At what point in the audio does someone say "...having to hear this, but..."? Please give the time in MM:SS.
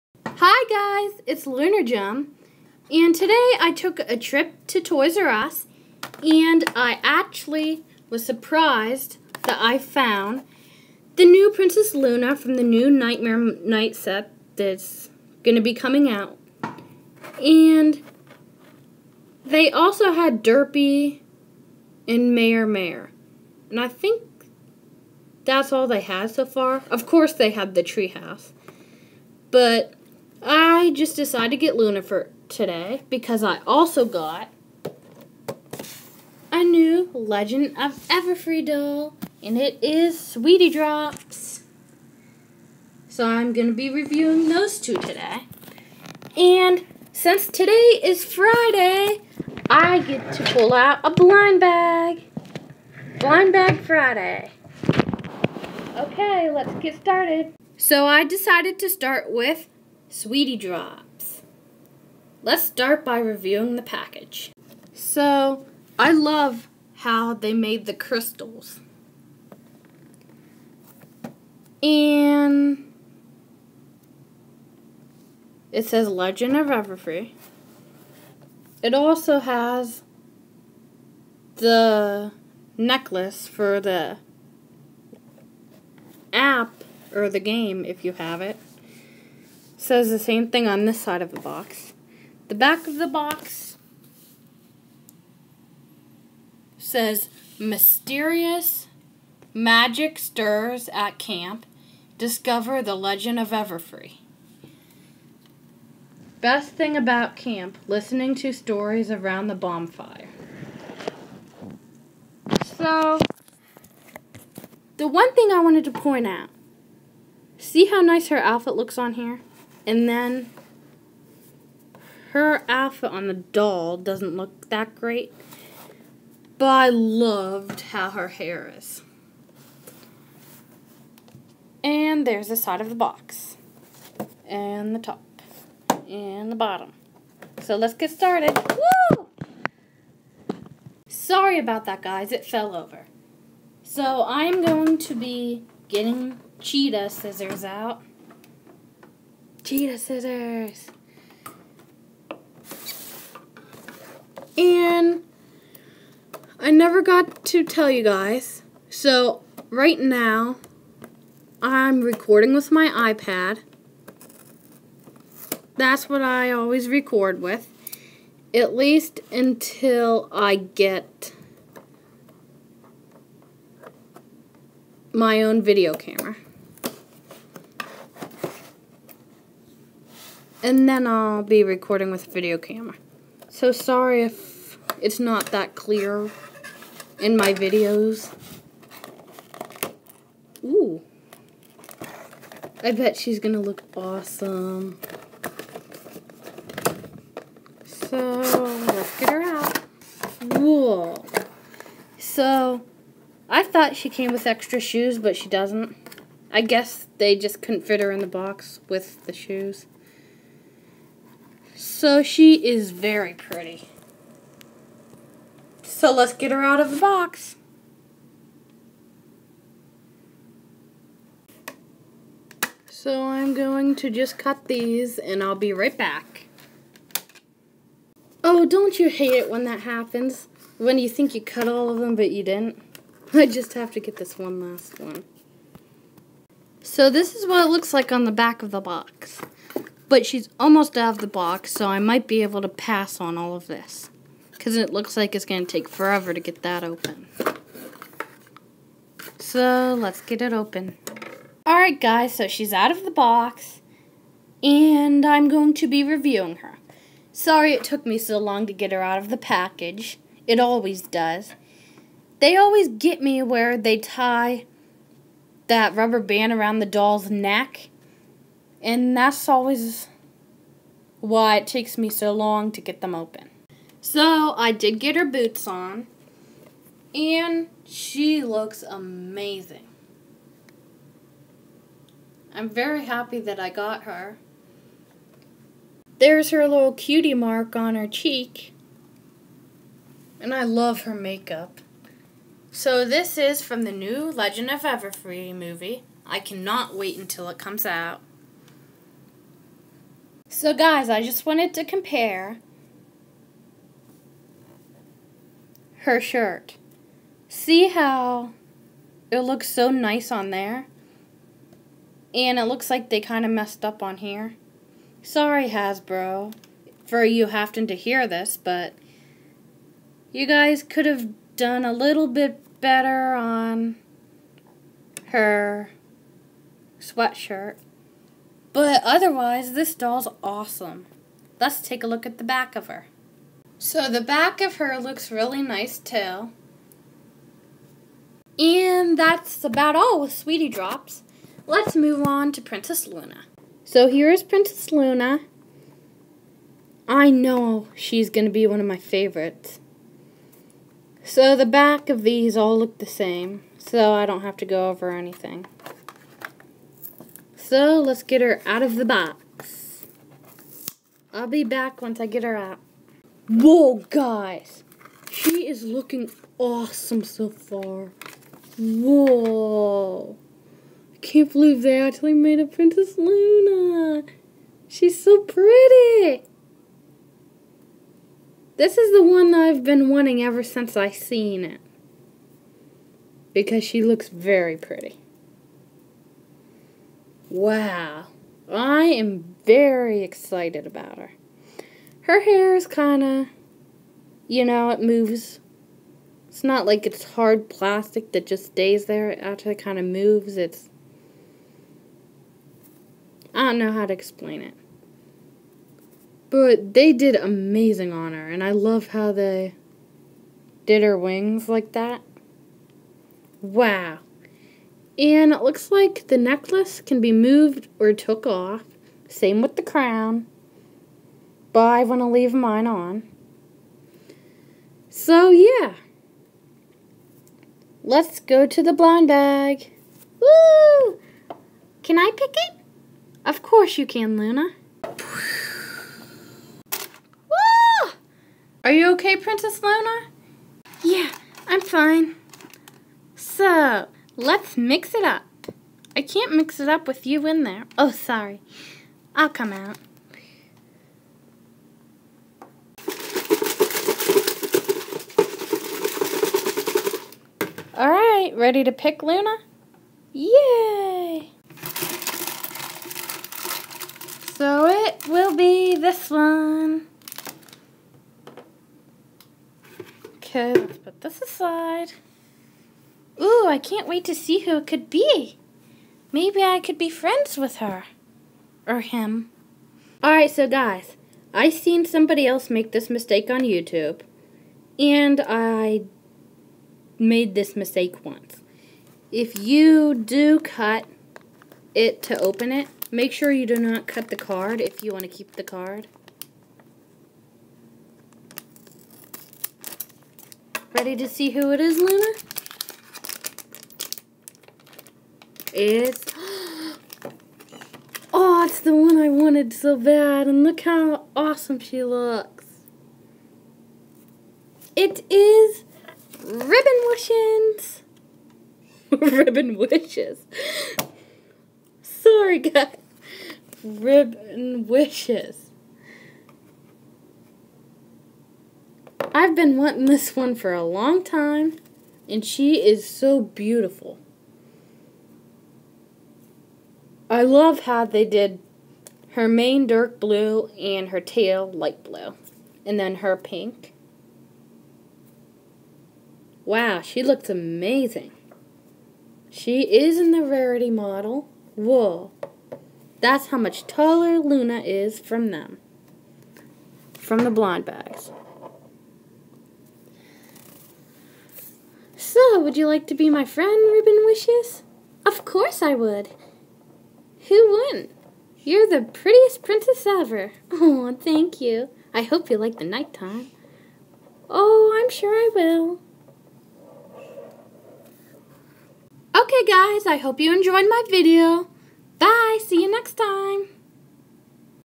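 05:17.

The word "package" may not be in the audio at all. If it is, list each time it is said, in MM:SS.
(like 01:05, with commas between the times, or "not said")
01:03, 04:19.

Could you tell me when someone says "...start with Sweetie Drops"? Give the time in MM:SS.
00:58.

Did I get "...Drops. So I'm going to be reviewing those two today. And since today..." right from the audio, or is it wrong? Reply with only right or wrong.
right.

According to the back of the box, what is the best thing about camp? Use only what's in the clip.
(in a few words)
Listening to stories around the bonfire.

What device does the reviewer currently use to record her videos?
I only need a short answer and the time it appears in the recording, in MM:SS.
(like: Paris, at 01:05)
iPad, at 02:42.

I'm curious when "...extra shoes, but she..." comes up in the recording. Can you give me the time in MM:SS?
03:24.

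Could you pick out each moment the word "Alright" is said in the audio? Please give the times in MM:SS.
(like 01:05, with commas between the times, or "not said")
04:11, 07:37, 08:00.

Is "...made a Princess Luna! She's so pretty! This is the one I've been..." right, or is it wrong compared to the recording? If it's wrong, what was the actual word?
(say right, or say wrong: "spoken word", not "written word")
right.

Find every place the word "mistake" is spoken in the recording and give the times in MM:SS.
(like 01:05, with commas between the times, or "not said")
08:03, 08:07.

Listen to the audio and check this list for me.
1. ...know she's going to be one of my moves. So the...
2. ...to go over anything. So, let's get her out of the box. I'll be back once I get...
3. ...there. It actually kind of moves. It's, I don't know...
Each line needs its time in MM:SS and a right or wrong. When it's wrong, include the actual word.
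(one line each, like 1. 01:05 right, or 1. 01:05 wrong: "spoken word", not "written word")
1. 05:47 wrong: "favorites", not "moves"
2. 05:54 right
3. 06:39 right.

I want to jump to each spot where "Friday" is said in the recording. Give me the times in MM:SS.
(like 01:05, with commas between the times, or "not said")
00:48, 00:53.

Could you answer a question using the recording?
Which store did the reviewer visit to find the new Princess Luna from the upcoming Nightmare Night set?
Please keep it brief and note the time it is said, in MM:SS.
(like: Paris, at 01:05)
Toys R Us, at 00:04.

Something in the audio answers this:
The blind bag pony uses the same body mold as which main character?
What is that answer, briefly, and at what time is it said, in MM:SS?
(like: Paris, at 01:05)
Rarity, at 09:10.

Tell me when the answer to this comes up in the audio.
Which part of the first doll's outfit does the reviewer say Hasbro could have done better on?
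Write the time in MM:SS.
05:26.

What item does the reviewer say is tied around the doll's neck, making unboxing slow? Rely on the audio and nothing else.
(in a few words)
rubber band.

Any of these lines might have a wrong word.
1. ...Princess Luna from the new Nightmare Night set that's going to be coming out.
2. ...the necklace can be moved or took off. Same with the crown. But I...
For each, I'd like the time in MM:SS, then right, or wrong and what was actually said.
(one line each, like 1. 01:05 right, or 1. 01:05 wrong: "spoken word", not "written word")
1. 00:11 right
2. 06:56 right.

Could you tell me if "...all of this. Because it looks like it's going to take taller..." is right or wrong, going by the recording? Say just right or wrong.
wrong.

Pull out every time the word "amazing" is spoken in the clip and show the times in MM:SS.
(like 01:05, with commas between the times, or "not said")
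04:38, 06:47, 09:07.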